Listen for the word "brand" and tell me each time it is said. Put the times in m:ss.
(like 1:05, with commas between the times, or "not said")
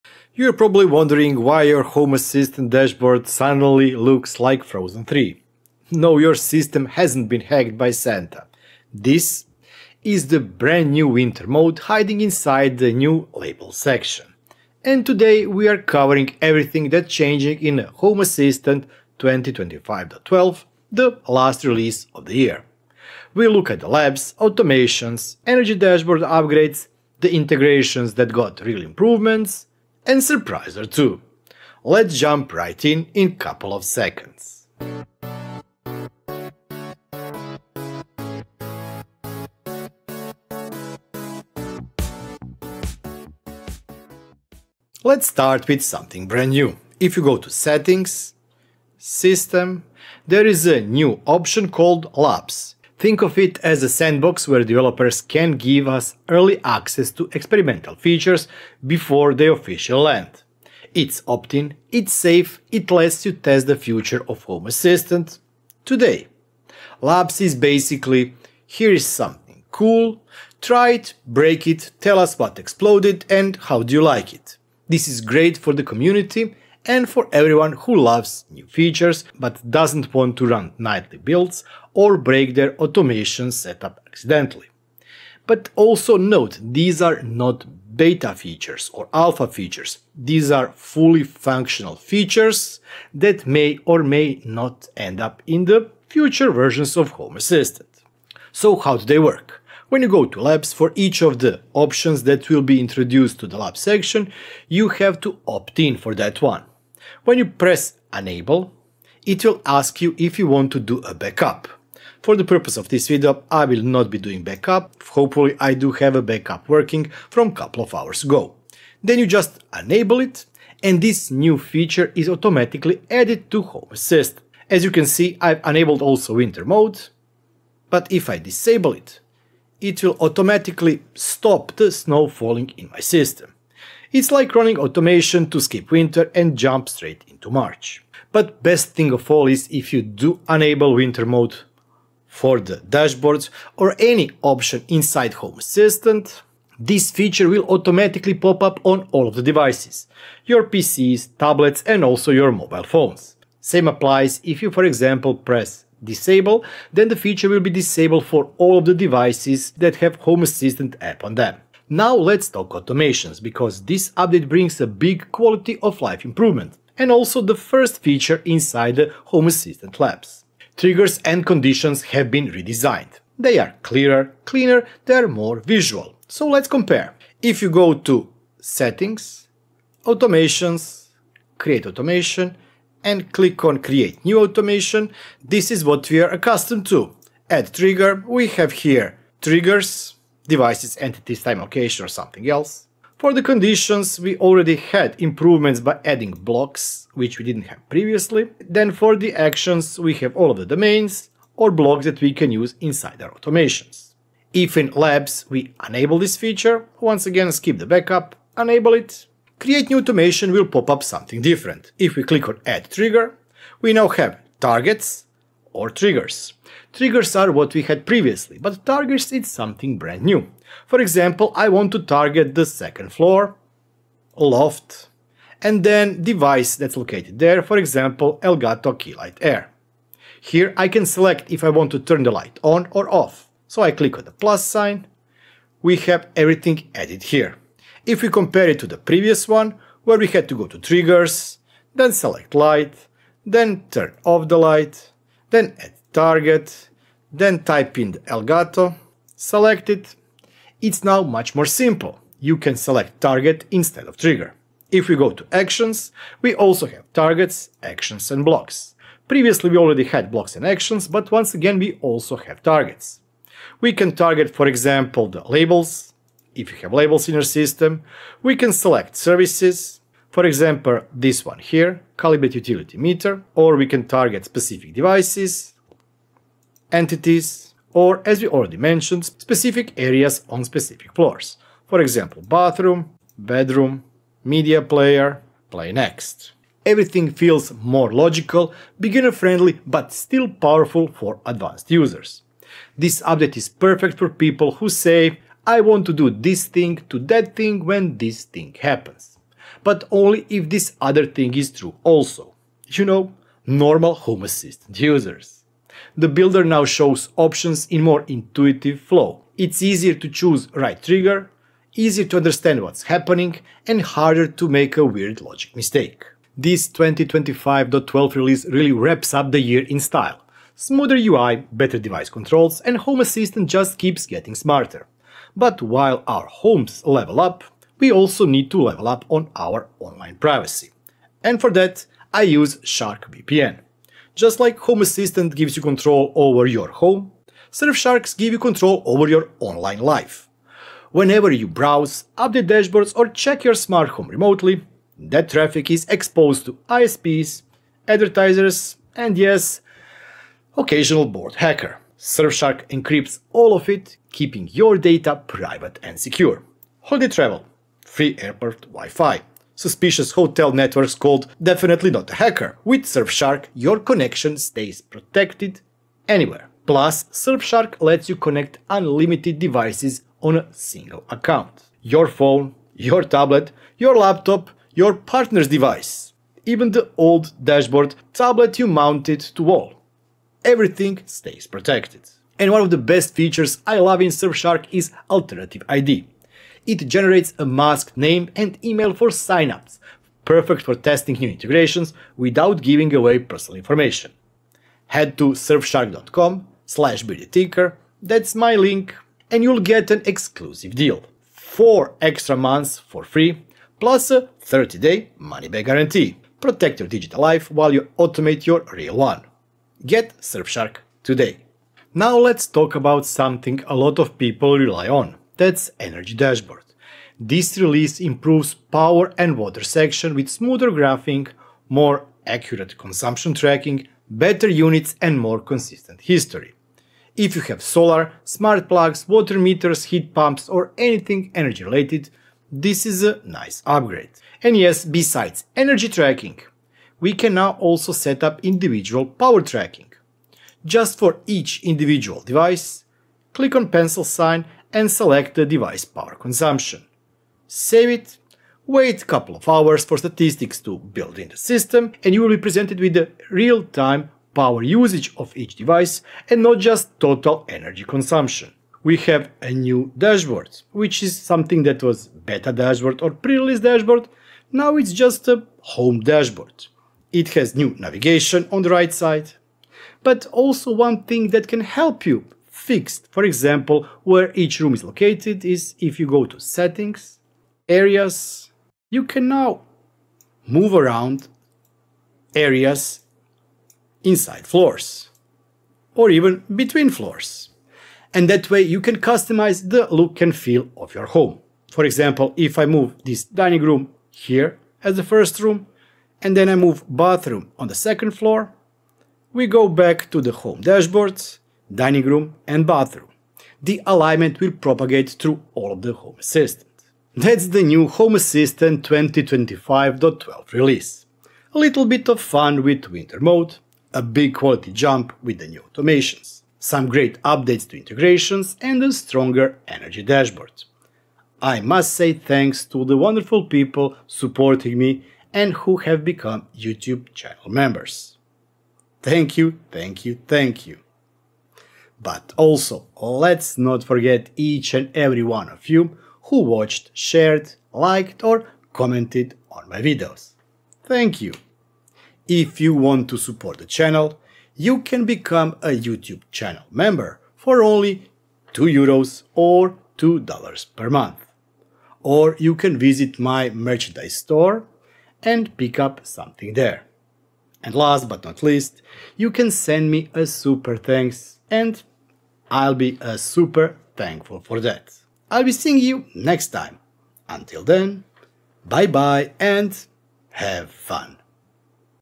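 0:10, 0:46, 3:39.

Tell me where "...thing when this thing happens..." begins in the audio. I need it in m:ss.
4:57.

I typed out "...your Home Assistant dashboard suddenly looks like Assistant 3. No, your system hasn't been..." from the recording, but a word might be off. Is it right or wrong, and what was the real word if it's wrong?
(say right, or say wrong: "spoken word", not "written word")
wrong: "Frozen", not "Assistant".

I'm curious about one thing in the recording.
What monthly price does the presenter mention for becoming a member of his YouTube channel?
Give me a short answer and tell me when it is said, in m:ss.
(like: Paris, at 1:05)
2 euros, at 9:08.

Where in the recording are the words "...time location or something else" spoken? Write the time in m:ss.
3:11.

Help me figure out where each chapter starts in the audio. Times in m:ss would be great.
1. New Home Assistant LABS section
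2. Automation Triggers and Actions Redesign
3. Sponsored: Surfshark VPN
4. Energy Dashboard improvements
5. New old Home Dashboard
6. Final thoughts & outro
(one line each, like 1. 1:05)
1. 0:44
2. 2:41
3. 5:16
4. 6:51
5. 7:38
6. 8:27.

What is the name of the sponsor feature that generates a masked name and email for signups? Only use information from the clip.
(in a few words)
Alternative ID.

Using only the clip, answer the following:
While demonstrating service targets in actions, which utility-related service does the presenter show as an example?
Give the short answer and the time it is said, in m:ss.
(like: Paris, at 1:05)
calibrate utility meter, at 4:32.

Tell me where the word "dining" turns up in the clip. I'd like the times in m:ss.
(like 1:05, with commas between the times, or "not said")
8:13, 8:21.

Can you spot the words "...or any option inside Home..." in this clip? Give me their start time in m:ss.
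2:23.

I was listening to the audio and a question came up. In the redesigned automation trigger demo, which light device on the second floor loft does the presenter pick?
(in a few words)
Elgato Keylight Air.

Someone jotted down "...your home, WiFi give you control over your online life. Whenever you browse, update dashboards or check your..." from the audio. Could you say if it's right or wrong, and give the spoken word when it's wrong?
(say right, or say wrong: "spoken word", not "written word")
wrong: "Surfsharks", not "WiFi".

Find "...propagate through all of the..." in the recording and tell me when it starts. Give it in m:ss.
8:24.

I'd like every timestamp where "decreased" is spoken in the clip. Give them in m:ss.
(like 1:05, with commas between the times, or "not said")
not said.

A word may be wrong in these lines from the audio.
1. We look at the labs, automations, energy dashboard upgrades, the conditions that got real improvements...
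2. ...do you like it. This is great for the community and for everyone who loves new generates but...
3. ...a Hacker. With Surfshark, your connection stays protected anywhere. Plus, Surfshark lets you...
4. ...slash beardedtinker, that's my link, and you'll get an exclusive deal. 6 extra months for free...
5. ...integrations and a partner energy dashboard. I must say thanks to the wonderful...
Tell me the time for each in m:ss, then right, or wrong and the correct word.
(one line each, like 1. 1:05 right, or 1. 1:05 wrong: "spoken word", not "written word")
1. 0:23 wrong: "integrations", not "conditions"
2. 1:13 wrong: "features", not "generates"
3. 6:02 right
4. 6:36 wrong: "4", not "6"
5. 8:37 wrong: "stronger", not "partner".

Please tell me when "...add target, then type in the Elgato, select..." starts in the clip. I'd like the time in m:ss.
4:05.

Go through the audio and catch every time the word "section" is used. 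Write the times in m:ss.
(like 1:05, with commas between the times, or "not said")
0:13, 1:43, 6:59.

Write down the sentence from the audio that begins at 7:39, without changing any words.
We have a new dashboard, which is something that was beta dashboard or pre-release dashboard, now it's just a home dashboard.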